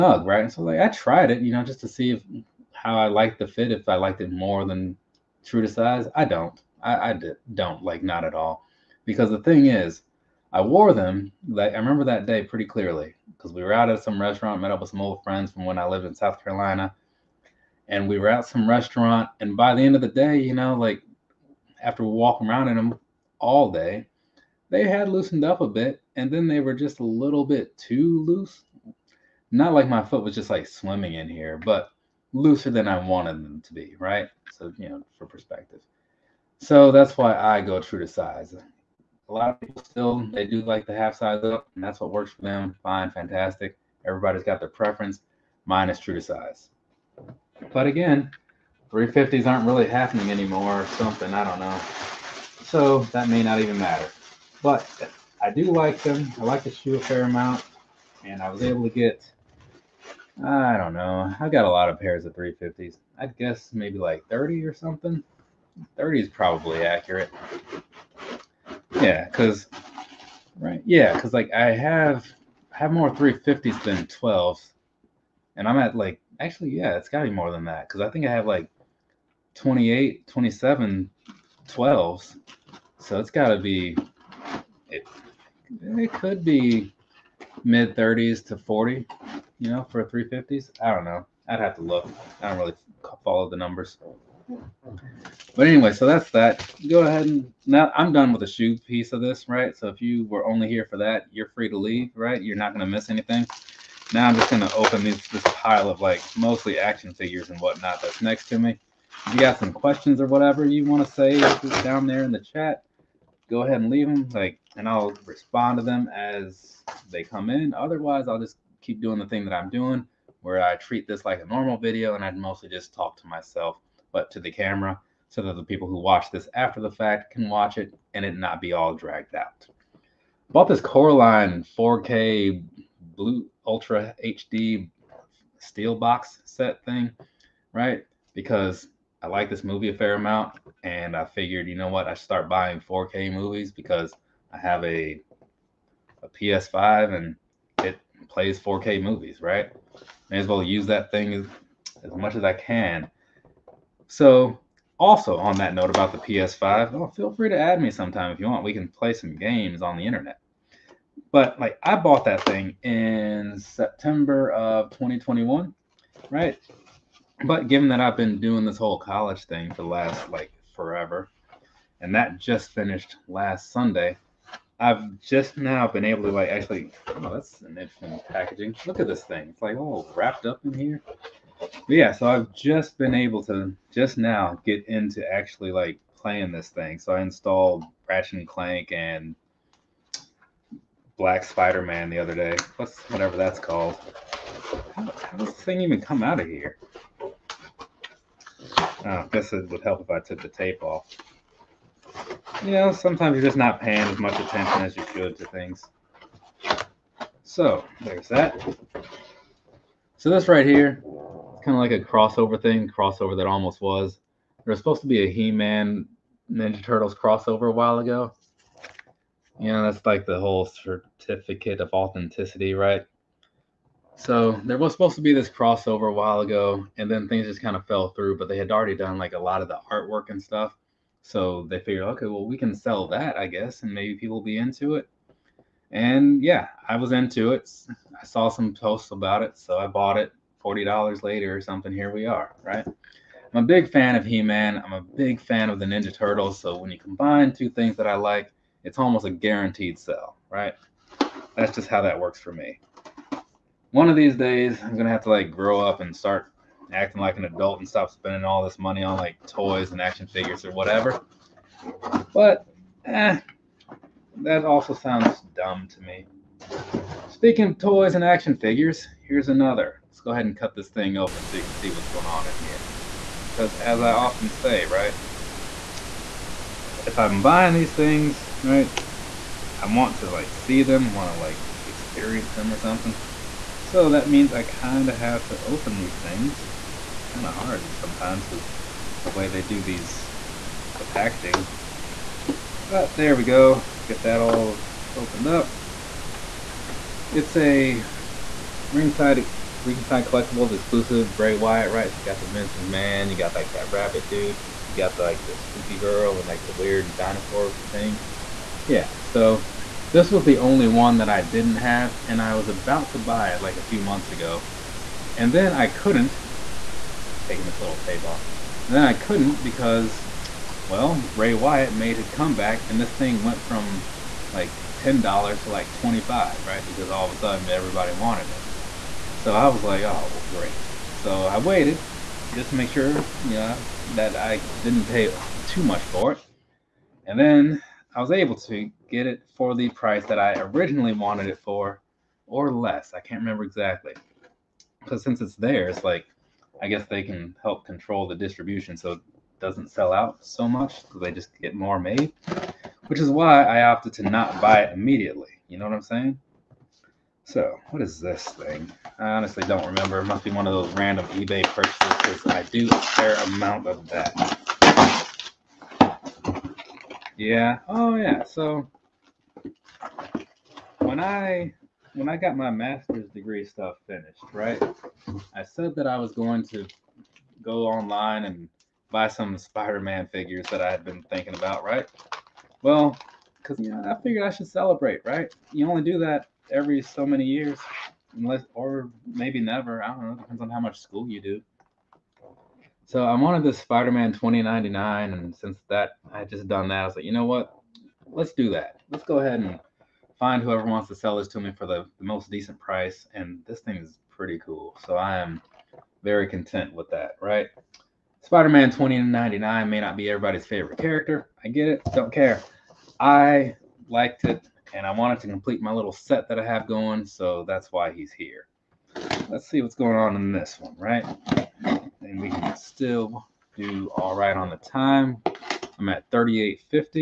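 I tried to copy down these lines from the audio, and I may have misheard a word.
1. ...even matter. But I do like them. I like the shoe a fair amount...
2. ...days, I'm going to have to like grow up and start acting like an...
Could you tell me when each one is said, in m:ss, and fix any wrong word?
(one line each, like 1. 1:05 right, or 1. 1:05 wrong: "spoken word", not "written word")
1. 0:53 right
2. 4:14 right.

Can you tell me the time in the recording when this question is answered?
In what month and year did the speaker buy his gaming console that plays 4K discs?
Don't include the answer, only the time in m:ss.
2:43.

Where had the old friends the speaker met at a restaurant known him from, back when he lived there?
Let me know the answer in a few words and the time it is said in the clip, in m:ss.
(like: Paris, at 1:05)
South Carolina, at 0:16.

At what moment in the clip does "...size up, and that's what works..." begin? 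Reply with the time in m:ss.
0:41.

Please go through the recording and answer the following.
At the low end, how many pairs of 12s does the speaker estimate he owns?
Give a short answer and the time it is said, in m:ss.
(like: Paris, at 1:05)
27, at 1:20.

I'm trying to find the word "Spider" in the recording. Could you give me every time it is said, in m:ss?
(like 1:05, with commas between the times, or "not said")
3:11, 6:19, 6:33, 6:48.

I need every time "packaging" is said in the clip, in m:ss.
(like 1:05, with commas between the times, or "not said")
2:58, 4:51.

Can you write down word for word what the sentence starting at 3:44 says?
So there was supposed to be this crossover a while ago, and then things just kind of fell through.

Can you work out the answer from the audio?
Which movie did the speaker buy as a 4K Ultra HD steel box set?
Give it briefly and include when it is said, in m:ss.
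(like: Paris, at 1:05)
Coraline, at 2:10.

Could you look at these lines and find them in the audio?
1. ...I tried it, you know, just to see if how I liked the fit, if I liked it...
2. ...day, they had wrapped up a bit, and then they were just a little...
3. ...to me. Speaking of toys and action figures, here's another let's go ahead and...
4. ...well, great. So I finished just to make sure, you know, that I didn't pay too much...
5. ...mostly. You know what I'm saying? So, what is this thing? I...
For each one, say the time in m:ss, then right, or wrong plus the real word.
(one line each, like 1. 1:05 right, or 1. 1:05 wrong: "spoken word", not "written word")
1. 0:00 right
2. 0:23 wrong: "loosened", not "wrapped"
3. 4:25 right
4. 5:30 wrong: "waited", not "finished"
5. 5:54 wrong: "immediately", not "mostly".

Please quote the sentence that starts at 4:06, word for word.
So when you combine two things that I like, it's almost a guaranteed sell, right?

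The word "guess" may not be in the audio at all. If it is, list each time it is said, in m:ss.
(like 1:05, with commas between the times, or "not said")
1:03, 3:19, 3:53, 5:46.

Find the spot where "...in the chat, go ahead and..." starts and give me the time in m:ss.
1:52.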